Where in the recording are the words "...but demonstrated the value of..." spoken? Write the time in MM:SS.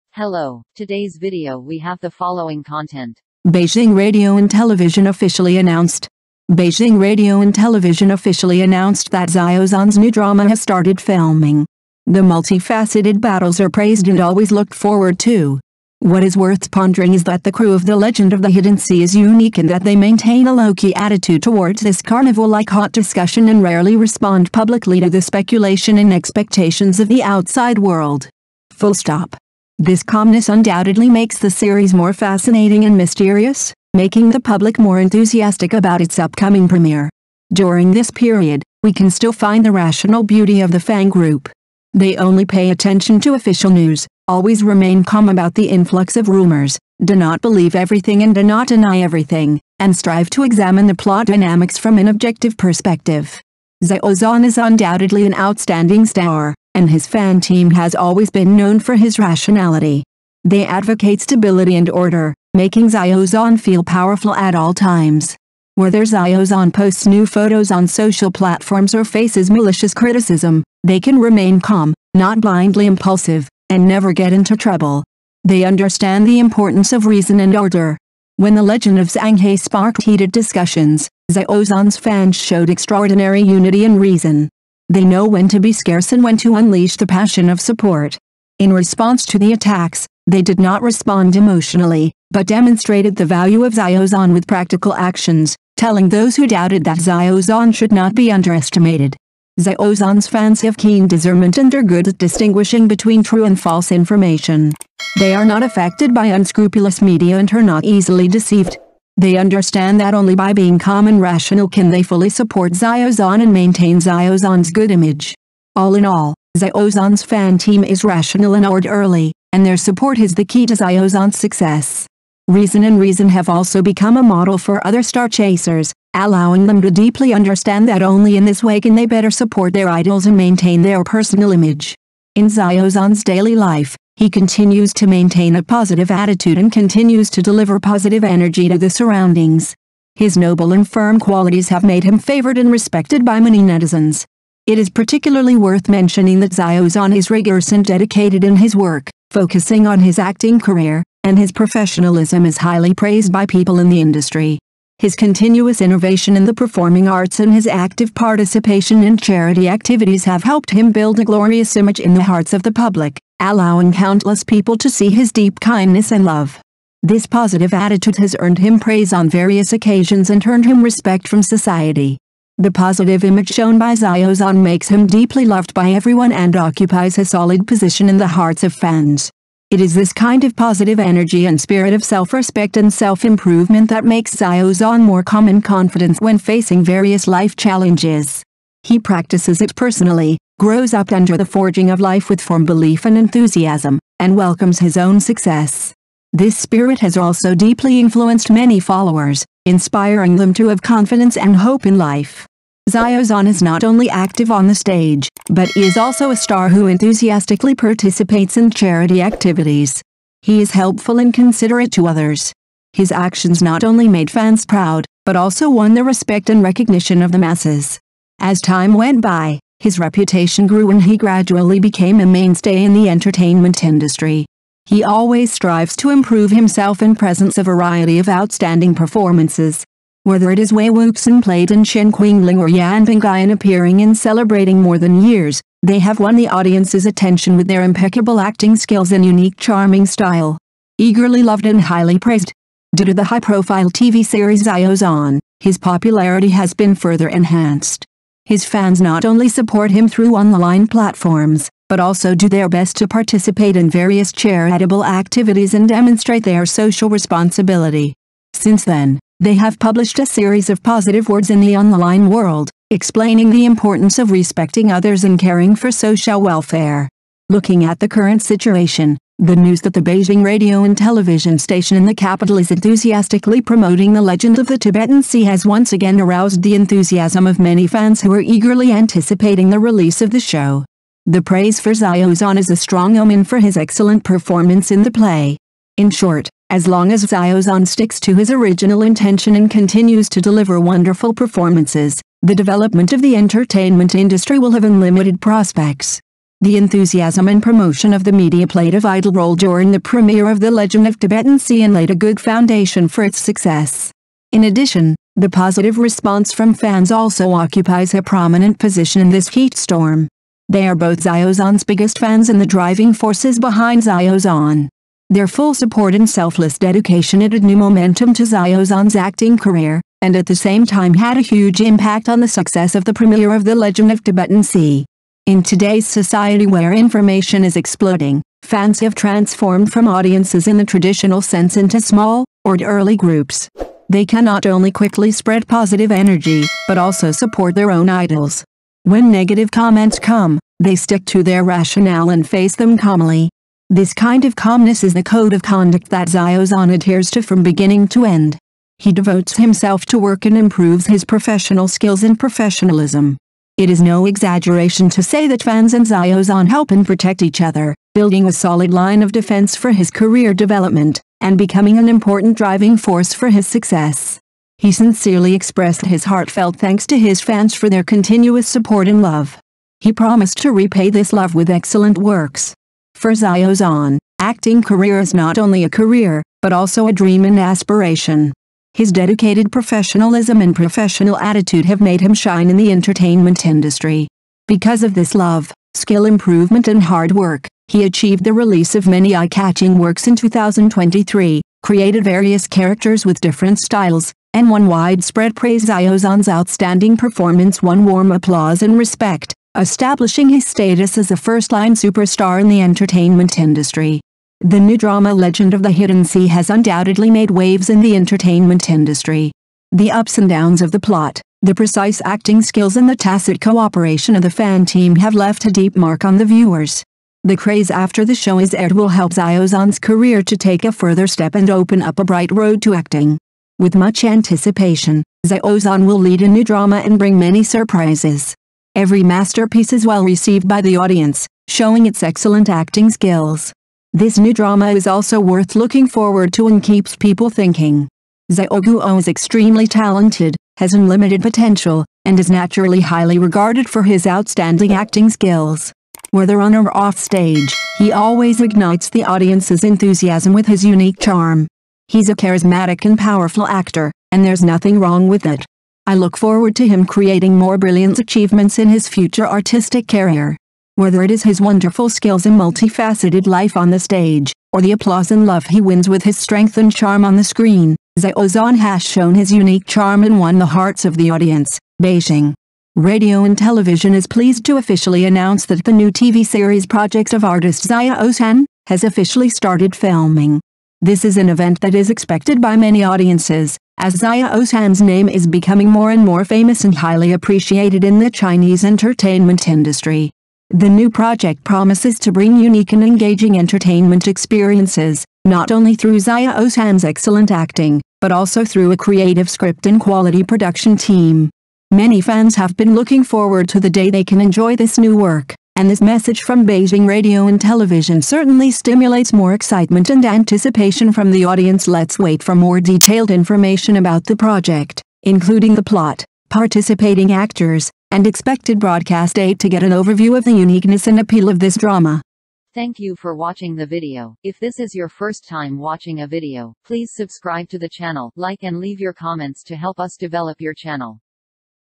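01:32.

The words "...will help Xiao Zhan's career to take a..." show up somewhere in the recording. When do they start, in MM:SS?
06:58.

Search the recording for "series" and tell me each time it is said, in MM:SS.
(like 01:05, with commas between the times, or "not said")
00:31, 04:04, 04:20, 07:56.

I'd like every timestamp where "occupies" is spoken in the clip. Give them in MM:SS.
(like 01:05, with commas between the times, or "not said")
02:56, 05:07.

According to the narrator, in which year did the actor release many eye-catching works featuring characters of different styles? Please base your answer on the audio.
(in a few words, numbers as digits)
2023.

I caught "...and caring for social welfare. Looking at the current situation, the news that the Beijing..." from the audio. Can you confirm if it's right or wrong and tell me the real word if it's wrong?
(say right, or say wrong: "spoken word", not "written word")
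right.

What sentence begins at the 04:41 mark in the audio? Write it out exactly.
The praise for Xiao Zhan is a strong omen for his excellent performance in the play.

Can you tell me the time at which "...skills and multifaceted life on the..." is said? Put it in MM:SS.
07:42.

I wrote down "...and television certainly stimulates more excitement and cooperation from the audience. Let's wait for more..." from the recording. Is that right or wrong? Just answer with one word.
wrong.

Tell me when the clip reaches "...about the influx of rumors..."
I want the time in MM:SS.
00:45.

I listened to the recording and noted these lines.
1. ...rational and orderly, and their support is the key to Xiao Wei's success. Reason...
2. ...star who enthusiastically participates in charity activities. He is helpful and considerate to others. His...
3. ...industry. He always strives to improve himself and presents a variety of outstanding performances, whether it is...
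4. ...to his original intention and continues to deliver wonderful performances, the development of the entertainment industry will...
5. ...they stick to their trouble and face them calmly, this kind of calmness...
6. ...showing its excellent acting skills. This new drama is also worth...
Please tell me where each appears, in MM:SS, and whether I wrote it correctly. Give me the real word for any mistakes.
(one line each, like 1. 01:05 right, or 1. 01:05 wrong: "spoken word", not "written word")
1. 01:58 wrong: "Zhan", not "Wei"
2. 03:26 right
3. 03:43 right
4. 04:48 right
5. 05:40 wrong: "rationale", not "trouble"
6. 07:11 right.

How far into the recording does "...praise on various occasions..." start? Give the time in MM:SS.
02:48.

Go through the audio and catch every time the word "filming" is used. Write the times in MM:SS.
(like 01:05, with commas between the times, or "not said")
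00:11, 07:59.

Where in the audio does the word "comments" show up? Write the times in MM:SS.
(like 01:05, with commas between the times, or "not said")
05:39, 08:49.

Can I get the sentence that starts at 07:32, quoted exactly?
He's a charismatic and powerful actor, and there's nothing wrong with it.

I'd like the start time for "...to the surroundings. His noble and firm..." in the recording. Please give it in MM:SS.
02:18.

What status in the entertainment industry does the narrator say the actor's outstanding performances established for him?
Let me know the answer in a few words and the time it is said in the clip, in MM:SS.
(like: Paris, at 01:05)
first-line superstar, at 06:41.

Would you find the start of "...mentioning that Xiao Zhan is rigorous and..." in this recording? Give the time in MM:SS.
02:25.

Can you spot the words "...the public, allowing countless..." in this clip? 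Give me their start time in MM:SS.
02:42.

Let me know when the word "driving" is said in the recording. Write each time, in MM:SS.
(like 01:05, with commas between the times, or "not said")
05:12, 06:02.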